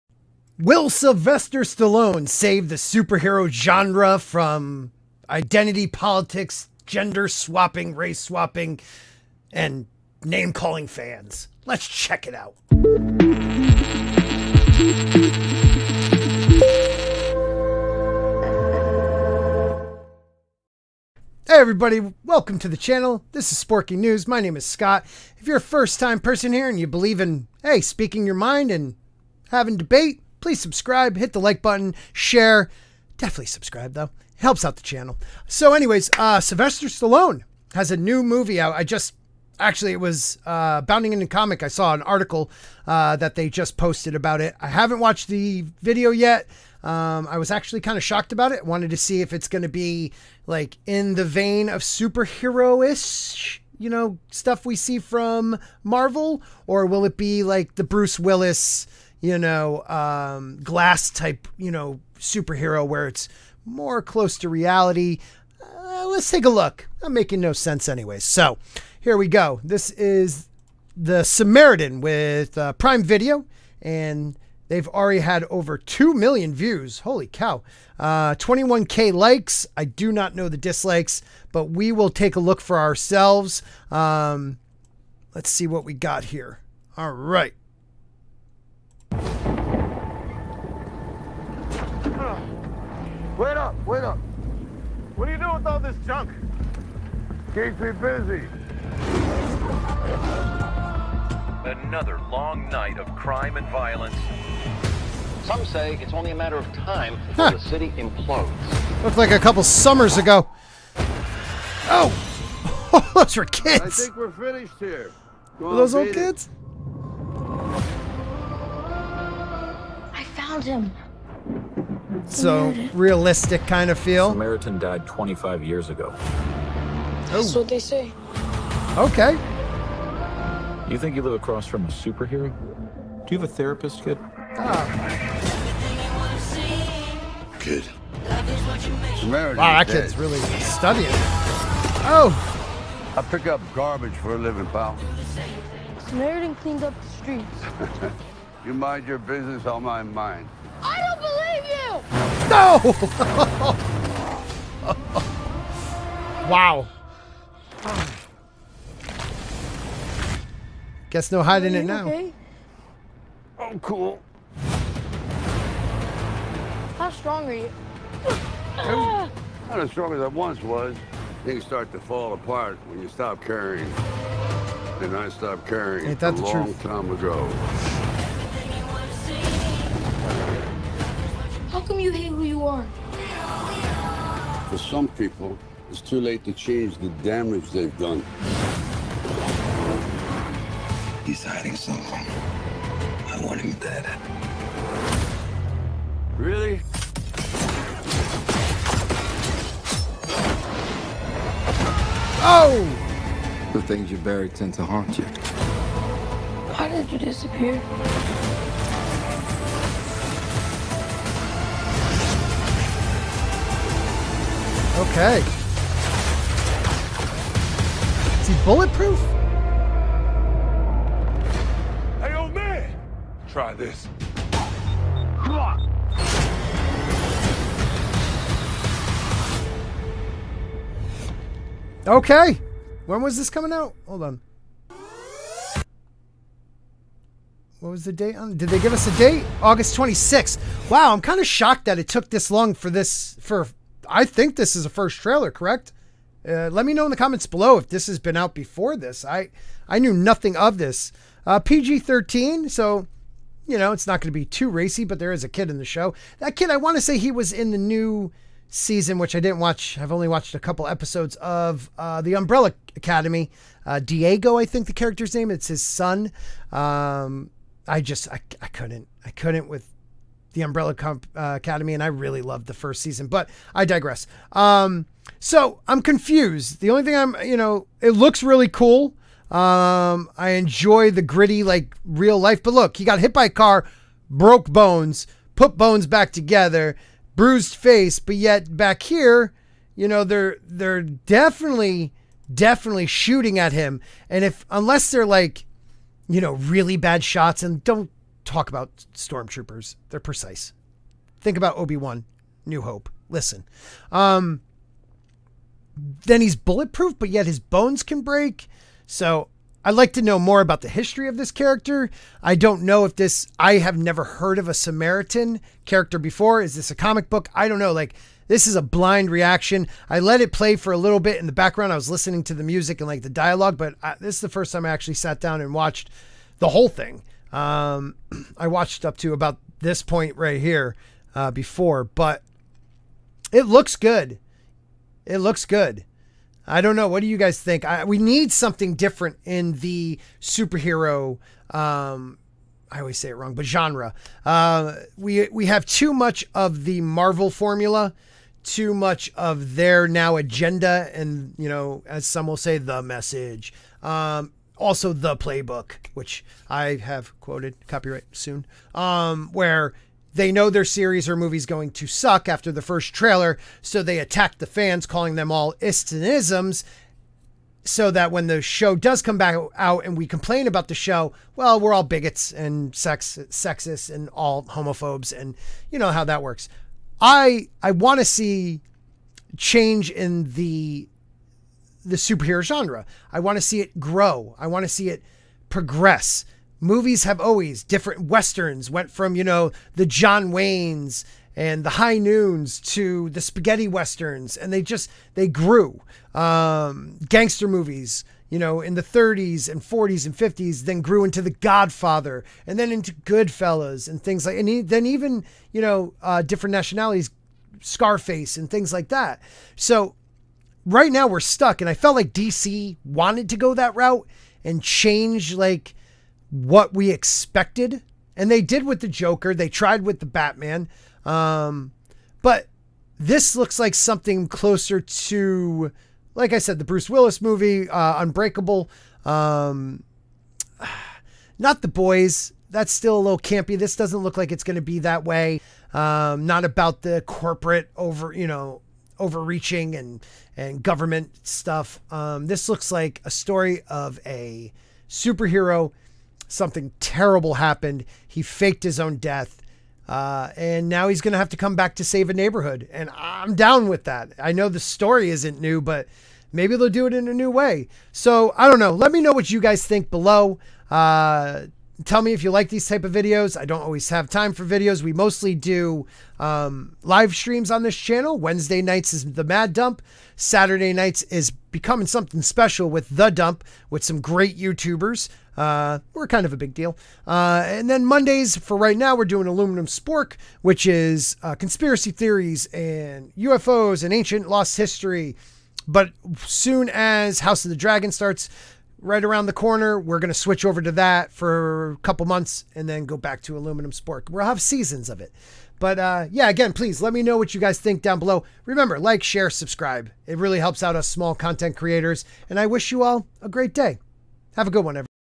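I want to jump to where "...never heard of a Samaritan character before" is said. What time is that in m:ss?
5:13.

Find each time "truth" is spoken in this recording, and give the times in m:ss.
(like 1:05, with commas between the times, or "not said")
2:56.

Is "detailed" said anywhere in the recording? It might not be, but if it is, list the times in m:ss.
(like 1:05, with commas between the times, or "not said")
not said.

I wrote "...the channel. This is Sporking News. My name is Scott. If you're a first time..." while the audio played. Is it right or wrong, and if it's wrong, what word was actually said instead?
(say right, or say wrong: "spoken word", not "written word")
right.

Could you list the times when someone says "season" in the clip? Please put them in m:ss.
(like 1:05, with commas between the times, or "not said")
4:18, 4:33, 8:14.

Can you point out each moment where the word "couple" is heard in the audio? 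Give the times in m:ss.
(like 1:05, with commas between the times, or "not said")
1:49, 4:20, 8:11.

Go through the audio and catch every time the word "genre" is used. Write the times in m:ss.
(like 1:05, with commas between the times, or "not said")
0:03, 5:43, 6:22.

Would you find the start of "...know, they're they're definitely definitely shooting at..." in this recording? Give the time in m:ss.
4:50.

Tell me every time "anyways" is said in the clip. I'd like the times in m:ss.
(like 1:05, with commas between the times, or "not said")
0:35, 1:07.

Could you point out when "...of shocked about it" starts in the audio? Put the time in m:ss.
0:47.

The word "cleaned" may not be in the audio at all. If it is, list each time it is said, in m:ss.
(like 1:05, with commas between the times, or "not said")
2:26.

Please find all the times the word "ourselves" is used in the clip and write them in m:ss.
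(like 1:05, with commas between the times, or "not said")
1:22.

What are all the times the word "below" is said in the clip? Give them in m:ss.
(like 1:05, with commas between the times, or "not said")
4:07, 7:40, 8:18.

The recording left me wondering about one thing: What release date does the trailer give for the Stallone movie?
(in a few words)
August 26th.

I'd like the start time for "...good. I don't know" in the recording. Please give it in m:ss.
5:35.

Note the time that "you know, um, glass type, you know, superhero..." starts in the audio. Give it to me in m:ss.
0:59.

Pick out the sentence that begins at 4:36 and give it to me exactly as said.
The only thing I'm, you know, it looks really cool.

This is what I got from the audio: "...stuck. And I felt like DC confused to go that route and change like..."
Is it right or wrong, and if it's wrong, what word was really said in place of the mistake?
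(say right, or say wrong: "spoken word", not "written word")
wrong: "wanted", not "confused".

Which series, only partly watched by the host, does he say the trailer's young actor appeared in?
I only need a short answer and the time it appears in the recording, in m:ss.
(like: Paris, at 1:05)
The Umbrella Academy, at 4:22.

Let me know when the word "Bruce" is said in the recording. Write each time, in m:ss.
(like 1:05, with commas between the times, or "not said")
0:57, 7:06.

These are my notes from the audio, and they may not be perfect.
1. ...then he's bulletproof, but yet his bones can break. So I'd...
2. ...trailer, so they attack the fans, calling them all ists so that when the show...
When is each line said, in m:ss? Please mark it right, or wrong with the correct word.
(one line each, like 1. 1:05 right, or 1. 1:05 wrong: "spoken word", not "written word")
1. 5:06 right
2. 6:03 right.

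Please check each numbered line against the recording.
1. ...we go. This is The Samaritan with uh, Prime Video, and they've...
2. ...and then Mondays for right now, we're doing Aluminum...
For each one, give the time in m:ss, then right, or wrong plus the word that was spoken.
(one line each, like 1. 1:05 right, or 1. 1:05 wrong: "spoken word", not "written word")
1. 1:09 right
2. 7:57 right.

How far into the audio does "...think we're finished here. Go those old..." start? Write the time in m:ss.
1:54.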